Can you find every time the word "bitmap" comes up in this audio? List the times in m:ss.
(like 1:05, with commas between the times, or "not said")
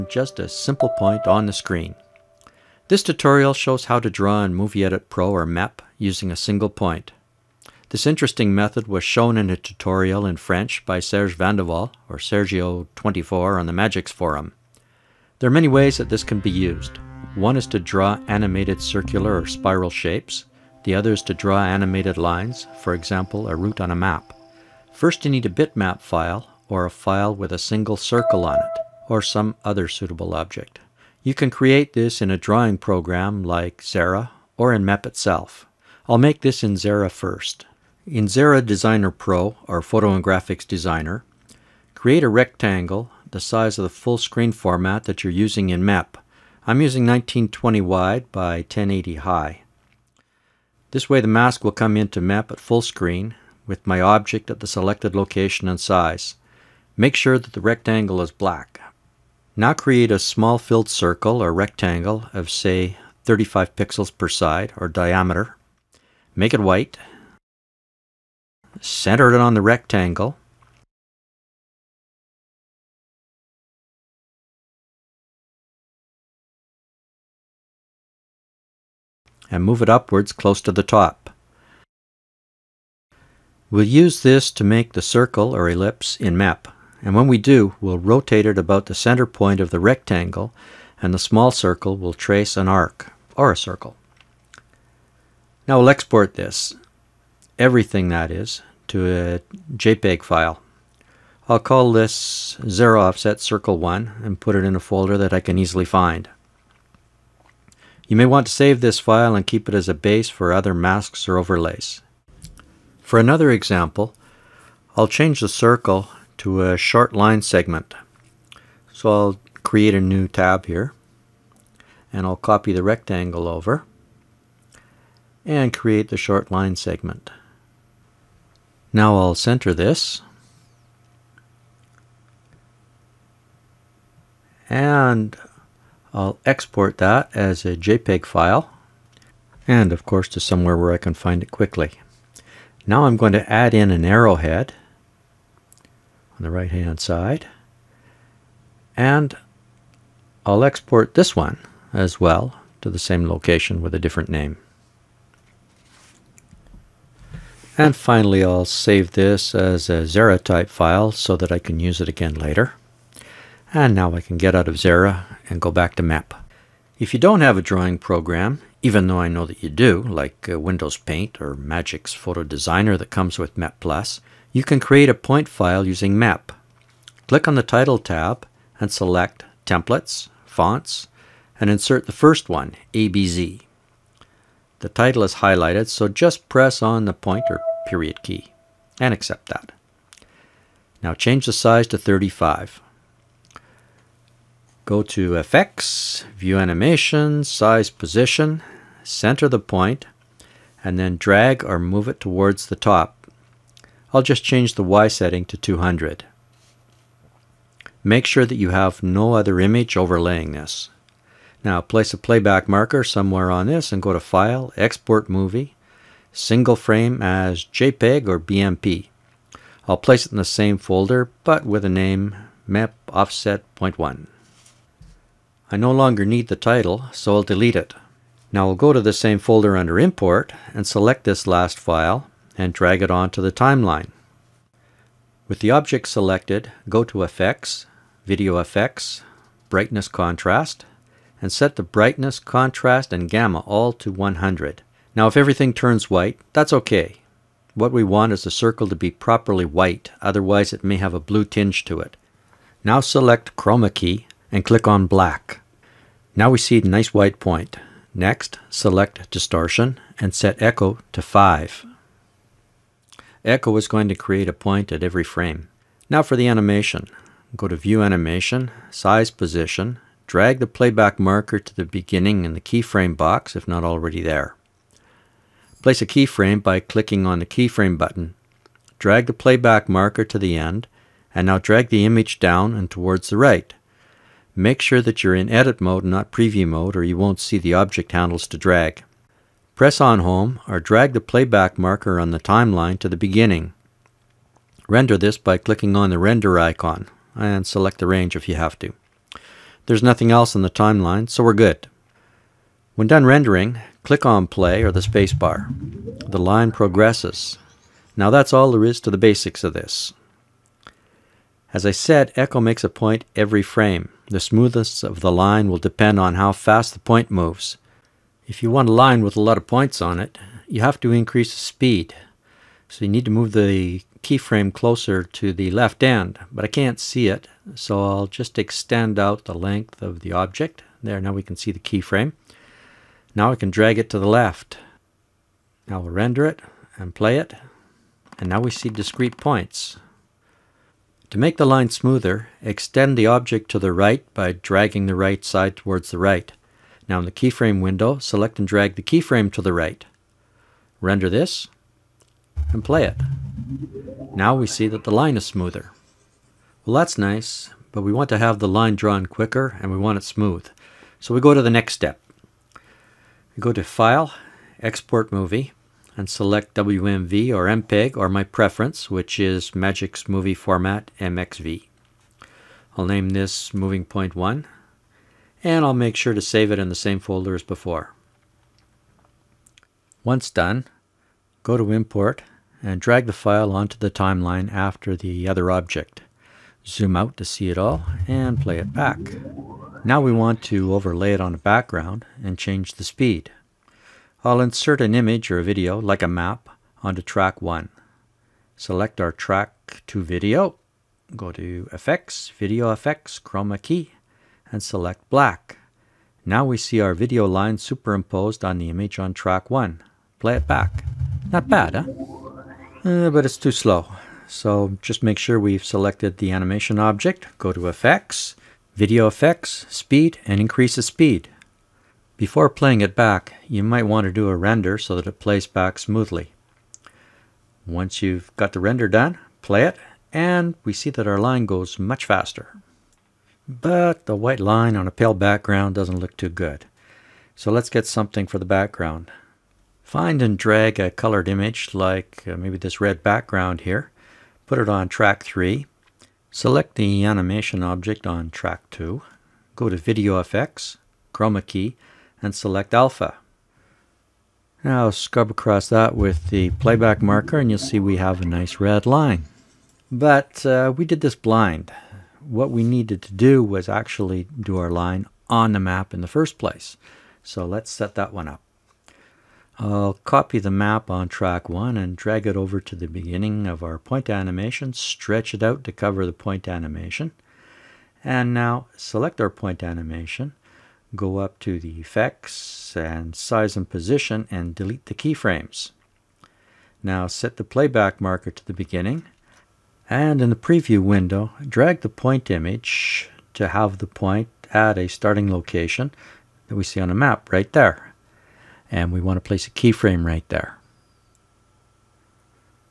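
0:25.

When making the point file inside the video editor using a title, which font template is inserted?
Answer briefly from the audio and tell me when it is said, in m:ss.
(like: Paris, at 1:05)
ABZ, at 3:02.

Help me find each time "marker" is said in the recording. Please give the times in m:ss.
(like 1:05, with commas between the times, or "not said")
3:32, 4:31, 4:39, 4:51, 7:37, 8:08.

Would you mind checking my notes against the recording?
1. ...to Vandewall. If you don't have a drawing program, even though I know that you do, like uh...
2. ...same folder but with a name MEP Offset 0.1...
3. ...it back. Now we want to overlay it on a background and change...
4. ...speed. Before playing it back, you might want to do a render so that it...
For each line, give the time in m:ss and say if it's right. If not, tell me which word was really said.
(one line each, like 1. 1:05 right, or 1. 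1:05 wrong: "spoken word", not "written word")
1. 2:45 wrong: "MEP", not "Vandewall"
2. 3:40 right
3. 6:28 right
4. 7:01 right.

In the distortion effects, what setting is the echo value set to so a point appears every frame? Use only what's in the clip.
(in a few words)
5.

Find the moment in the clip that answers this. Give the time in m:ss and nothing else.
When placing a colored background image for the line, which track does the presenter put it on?
7:25.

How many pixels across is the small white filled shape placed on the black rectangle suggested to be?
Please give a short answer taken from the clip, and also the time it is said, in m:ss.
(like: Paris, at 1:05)
35, at 1:03.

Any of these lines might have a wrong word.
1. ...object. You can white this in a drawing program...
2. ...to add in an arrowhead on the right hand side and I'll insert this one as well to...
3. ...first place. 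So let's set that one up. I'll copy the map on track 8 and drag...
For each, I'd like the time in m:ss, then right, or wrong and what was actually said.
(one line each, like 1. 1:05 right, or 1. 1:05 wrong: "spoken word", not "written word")
1. 0:30 wrong: "create", not "white"
2. 2:23 wrong: "export", not "insert"
3. 7:46 wrong: "1", not "8".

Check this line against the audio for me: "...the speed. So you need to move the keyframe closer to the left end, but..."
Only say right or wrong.
right.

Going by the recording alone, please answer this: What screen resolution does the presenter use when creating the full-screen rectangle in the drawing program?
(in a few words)
1920 by 1080.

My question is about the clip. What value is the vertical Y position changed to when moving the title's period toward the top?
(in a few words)
200.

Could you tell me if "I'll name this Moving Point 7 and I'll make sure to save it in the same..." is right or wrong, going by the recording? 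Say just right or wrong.
wrong.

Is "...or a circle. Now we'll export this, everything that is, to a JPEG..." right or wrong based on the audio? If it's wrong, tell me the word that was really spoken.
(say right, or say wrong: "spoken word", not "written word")
right.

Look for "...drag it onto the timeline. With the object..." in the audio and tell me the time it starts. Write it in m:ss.
3:52.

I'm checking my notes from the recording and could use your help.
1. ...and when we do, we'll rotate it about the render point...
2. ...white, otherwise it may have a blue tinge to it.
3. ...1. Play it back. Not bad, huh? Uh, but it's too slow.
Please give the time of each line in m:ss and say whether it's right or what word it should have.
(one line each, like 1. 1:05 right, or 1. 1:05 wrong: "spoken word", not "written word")
1. 1:27 wrong: "center", not "render"
2. 4:09 right
3. 6:49 right.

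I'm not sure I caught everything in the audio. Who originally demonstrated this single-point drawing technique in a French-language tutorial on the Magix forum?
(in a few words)
Serge Vandewall.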